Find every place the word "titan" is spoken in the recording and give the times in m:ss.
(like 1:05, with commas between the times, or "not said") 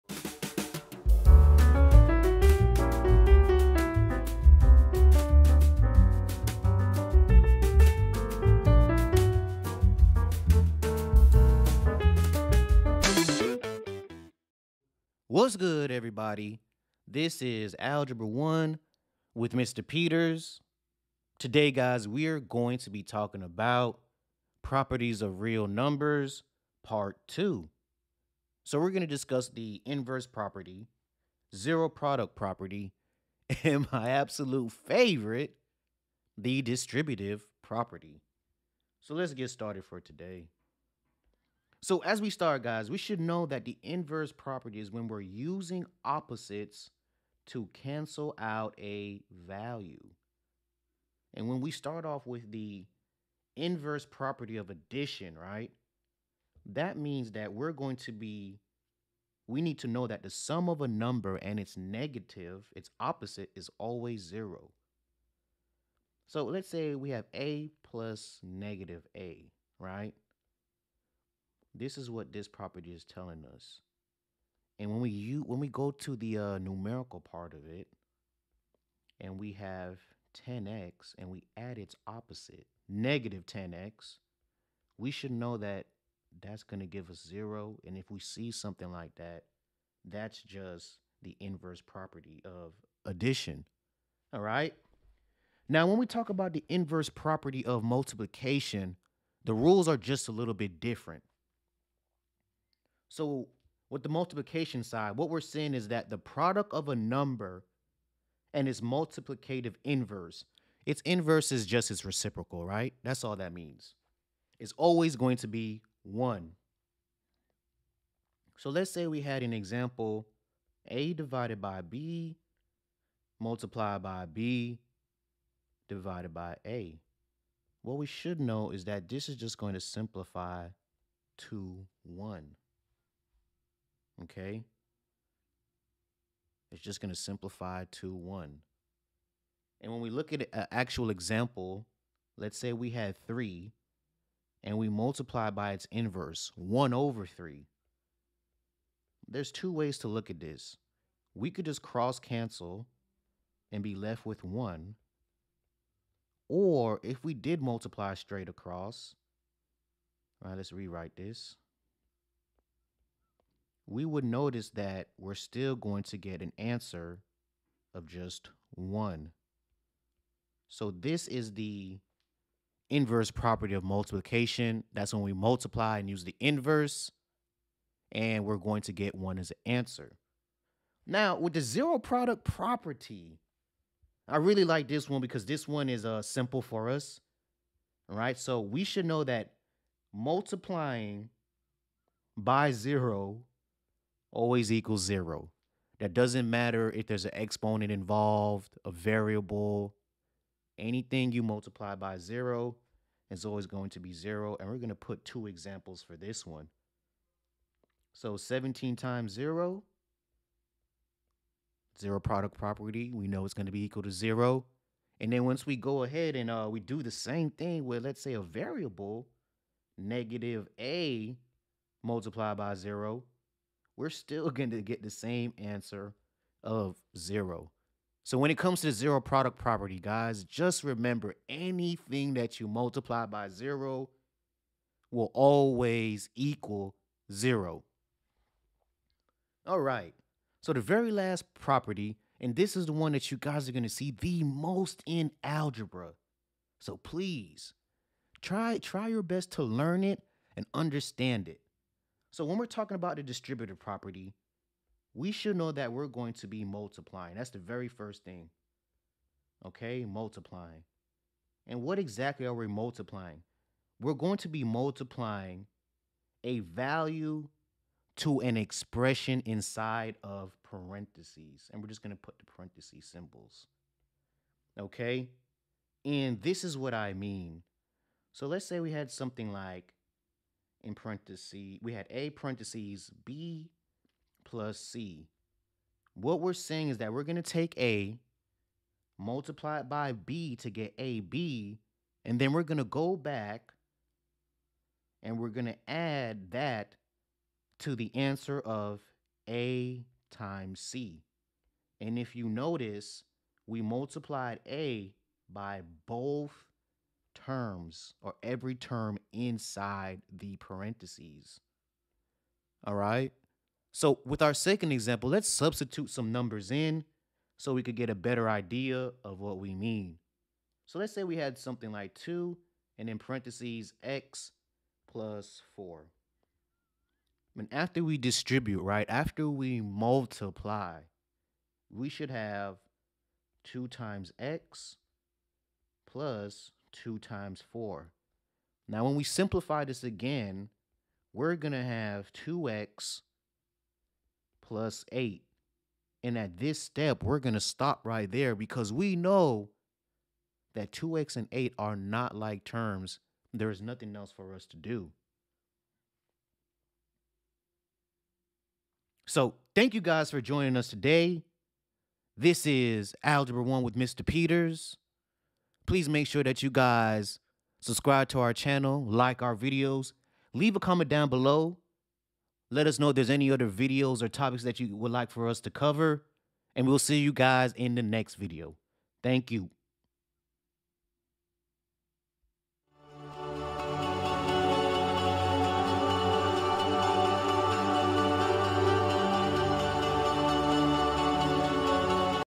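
not said.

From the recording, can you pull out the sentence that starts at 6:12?
Let us know if there's any other videos or topics that you would like for us to cover.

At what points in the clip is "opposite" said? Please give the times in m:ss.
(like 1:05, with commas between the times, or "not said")
0:46, 1:02, 1:22.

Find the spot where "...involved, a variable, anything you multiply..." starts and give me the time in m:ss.
3:17.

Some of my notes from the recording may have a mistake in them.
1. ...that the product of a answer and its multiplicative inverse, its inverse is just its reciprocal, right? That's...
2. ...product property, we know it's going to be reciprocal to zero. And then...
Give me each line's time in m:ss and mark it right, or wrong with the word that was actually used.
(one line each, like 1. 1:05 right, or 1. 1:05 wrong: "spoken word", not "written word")
1. 1:45 wrong: "number", not "answer"
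2. 3:32 wrong: "equal", not "reciprocal".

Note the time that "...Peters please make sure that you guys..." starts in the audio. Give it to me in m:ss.
6:04.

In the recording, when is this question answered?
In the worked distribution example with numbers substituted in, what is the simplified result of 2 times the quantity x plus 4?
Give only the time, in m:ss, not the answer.
5:42.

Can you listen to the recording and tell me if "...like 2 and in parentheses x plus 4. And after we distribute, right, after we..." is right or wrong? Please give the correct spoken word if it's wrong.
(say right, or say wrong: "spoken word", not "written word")
right.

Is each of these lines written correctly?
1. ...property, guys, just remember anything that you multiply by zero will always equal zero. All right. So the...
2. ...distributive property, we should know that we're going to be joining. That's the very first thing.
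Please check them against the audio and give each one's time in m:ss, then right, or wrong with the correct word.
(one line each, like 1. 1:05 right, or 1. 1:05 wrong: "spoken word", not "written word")
1. 3:49 right
2. 4:13 wrong: "multiplying", not "joining".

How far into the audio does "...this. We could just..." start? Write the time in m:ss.
2:30.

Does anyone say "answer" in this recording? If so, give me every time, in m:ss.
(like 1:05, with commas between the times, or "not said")
2:46, 2:59, 3:45, 4:58.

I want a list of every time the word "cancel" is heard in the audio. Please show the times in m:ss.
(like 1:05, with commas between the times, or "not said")
0:47, 2:32.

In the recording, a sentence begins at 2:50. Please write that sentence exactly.
So this is the inverse property of multiplication.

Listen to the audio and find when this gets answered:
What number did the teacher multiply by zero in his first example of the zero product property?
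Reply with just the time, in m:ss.
3:28.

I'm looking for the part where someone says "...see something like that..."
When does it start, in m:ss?
1:28.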